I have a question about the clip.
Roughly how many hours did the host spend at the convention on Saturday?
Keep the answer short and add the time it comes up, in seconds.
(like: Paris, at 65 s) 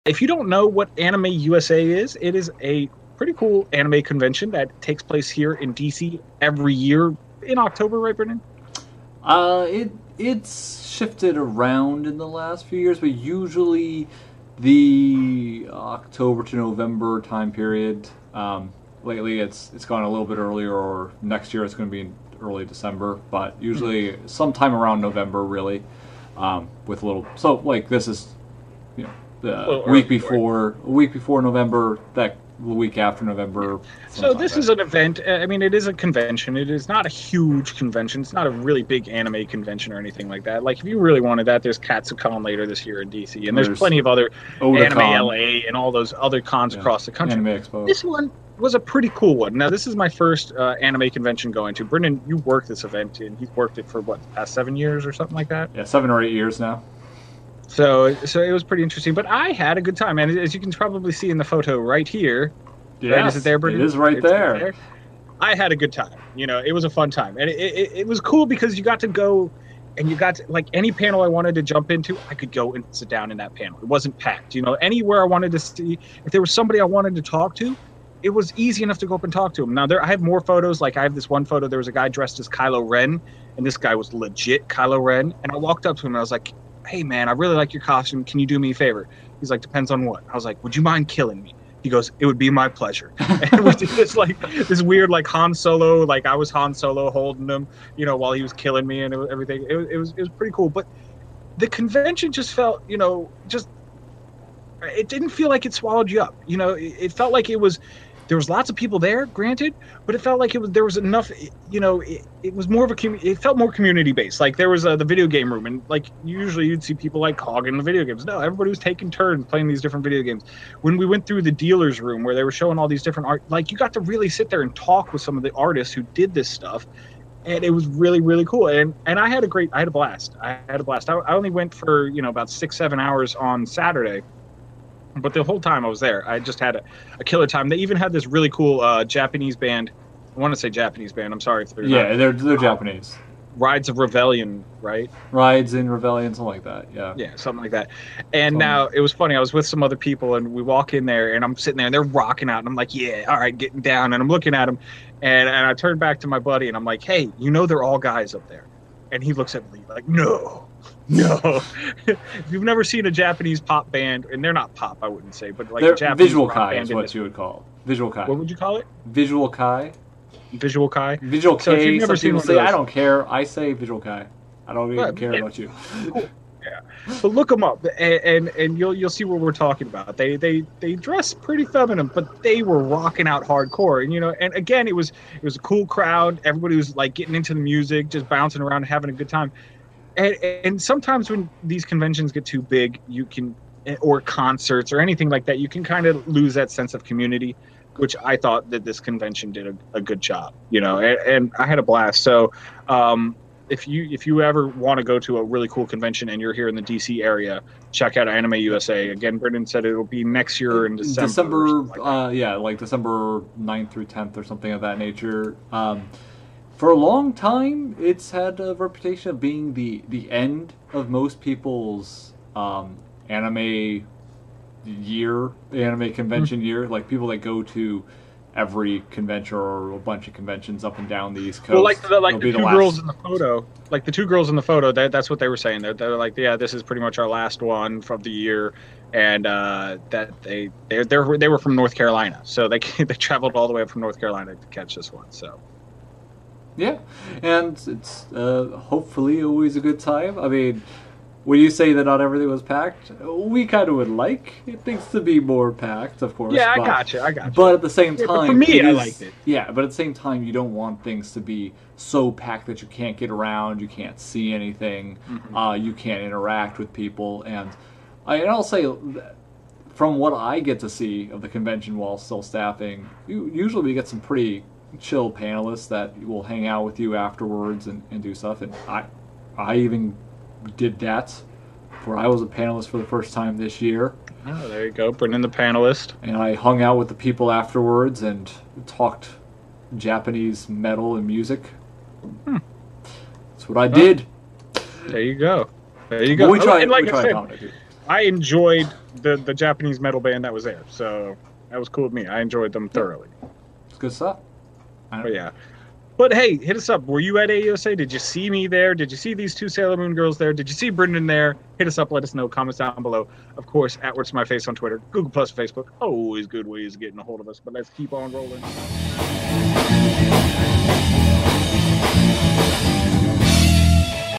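6 or 7 hours, at 132 s.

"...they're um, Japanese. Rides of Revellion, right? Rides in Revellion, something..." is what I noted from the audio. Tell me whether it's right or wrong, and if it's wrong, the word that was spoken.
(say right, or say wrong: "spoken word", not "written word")
right.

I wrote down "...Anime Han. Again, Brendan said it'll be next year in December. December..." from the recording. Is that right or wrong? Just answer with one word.
wrong.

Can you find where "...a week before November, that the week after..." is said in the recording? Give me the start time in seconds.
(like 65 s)
30 s.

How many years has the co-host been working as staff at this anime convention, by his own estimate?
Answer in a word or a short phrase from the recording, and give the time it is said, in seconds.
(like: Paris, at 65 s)
7 or 8 years, at 55 s.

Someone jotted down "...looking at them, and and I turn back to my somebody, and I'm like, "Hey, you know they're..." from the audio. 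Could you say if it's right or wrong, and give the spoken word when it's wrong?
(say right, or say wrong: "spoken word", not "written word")
wrong: "buddy", not "somebody".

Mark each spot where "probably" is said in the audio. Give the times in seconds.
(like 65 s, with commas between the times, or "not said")
60 s.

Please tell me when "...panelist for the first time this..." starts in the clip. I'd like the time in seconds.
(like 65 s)
282 s.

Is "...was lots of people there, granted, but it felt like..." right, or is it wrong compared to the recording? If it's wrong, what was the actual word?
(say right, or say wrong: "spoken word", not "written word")
right.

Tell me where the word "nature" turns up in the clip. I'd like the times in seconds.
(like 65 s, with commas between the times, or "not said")
214 s.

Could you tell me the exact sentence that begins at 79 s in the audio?
Now there, I have more photos.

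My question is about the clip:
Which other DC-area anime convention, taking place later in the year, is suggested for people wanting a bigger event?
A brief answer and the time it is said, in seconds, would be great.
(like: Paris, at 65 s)
Katsucon, at 41 s.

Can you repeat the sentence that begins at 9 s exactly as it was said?
Uh, it it's shifted around in the last few years, but usually the October to November time period.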